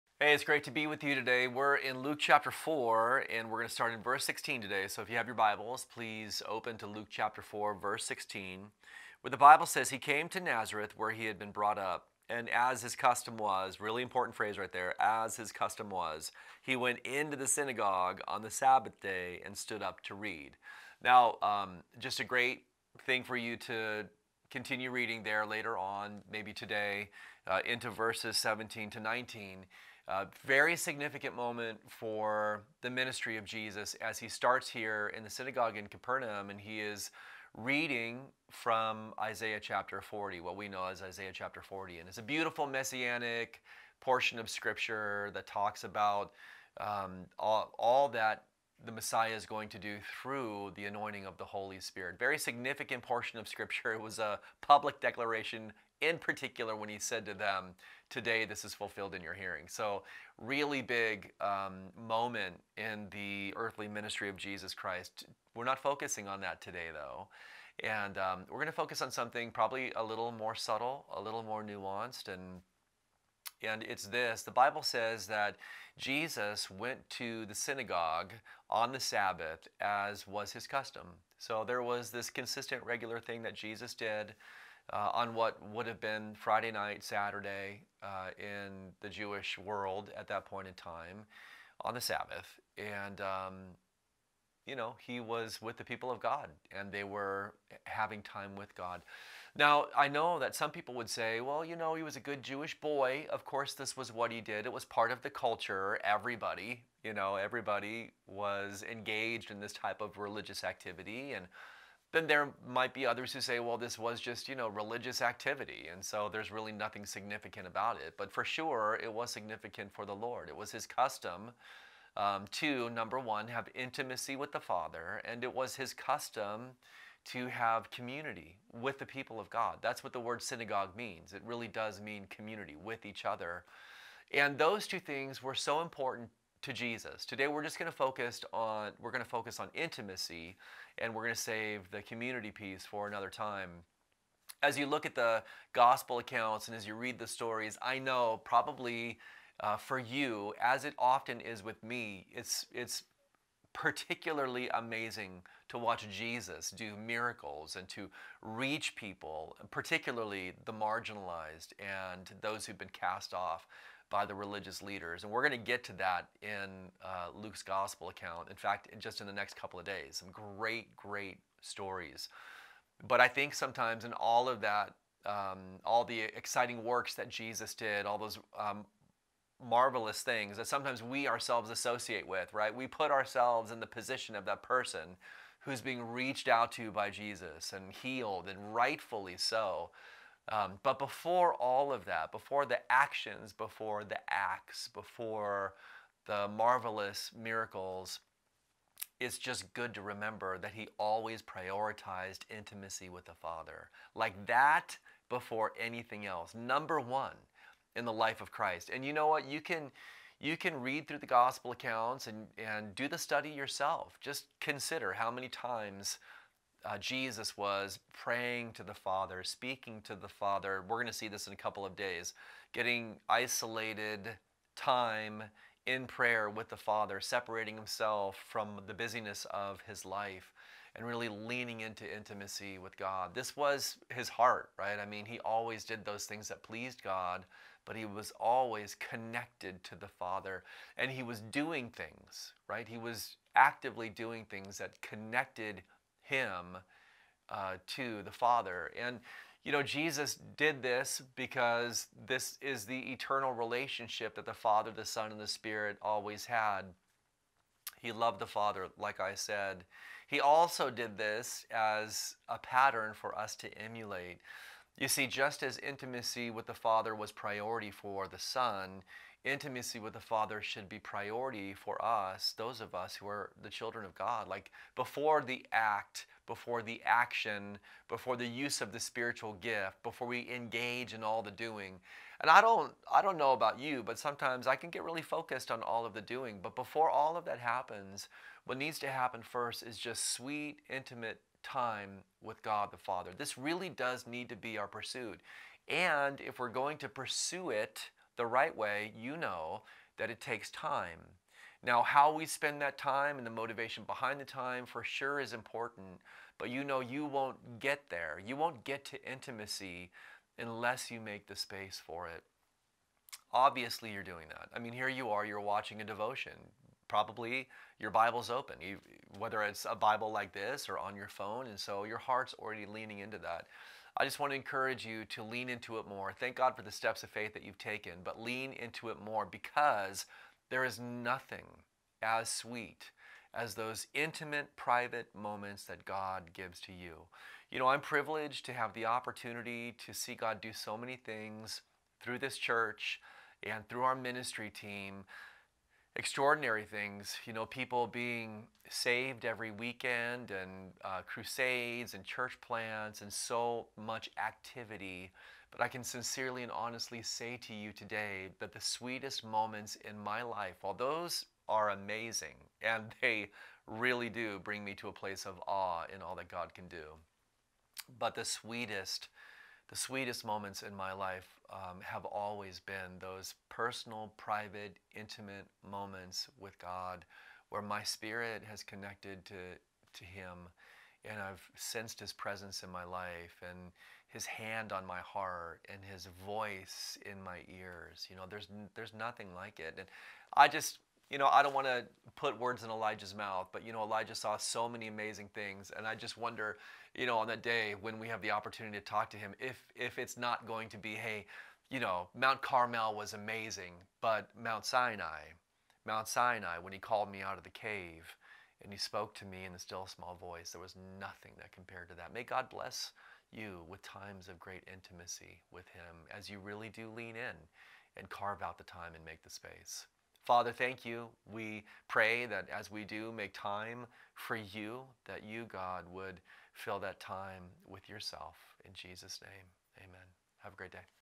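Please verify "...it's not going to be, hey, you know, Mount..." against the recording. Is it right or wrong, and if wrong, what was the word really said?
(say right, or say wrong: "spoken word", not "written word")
right.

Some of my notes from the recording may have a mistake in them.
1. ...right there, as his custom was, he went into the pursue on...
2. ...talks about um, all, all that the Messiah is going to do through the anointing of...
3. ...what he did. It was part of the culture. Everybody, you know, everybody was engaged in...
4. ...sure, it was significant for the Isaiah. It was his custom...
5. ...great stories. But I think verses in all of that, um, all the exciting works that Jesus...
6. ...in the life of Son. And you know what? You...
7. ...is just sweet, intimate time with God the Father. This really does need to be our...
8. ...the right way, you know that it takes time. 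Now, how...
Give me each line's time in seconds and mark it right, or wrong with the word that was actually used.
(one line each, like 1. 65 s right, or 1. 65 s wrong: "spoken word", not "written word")
1. 14 s wrong: "synagogue", not "pursue"
2. 45 s right
3. 104 s right
4. 118 s wrong: "Lord", not "Isaiah"
5. 170 s wrong: "sometimes", not "verses"
6. 207 s wrong: "Christ", not "Son"
7. 289 s right
8. 298 s right.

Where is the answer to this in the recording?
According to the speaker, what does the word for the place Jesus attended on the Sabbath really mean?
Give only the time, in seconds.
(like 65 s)
132 s.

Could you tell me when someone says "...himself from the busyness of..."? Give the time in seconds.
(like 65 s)
227 s.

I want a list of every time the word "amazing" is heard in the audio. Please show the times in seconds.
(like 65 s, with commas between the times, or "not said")
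154 s, 361 s, 395 s, 403 s.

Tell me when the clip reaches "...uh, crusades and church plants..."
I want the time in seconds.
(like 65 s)
351 s.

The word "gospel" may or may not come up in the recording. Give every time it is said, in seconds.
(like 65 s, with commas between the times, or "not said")
145 s, 167 s, 211 s.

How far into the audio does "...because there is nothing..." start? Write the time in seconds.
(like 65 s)
329 s.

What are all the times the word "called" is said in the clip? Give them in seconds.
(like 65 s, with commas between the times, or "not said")
406 s.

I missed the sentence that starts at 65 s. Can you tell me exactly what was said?
We're not focusing on that today, though.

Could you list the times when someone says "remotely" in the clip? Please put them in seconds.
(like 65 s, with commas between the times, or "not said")
not said.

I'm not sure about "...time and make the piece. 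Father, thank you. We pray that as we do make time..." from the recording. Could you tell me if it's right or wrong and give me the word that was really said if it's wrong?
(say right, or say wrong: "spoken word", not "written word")
wrong: "space", not "piece".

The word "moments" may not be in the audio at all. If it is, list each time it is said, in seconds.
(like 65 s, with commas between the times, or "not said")
31 s, 61 s, 335 s, 359 s, 370 s, 375 s.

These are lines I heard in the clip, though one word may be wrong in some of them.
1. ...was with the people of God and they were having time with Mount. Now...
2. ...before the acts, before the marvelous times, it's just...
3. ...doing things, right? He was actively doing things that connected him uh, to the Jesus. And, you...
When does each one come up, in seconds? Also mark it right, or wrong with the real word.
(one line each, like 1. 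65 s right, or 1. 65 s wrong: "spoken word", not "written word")
1. 95 s wrong: "God", not "Mount"
2. 193 s wrong: "miracles", not "times"
3. 241 s wrong: "Father", not "Jesus".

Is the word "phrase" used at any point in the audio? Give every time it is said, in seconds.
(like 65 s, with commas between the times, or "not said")
14 s.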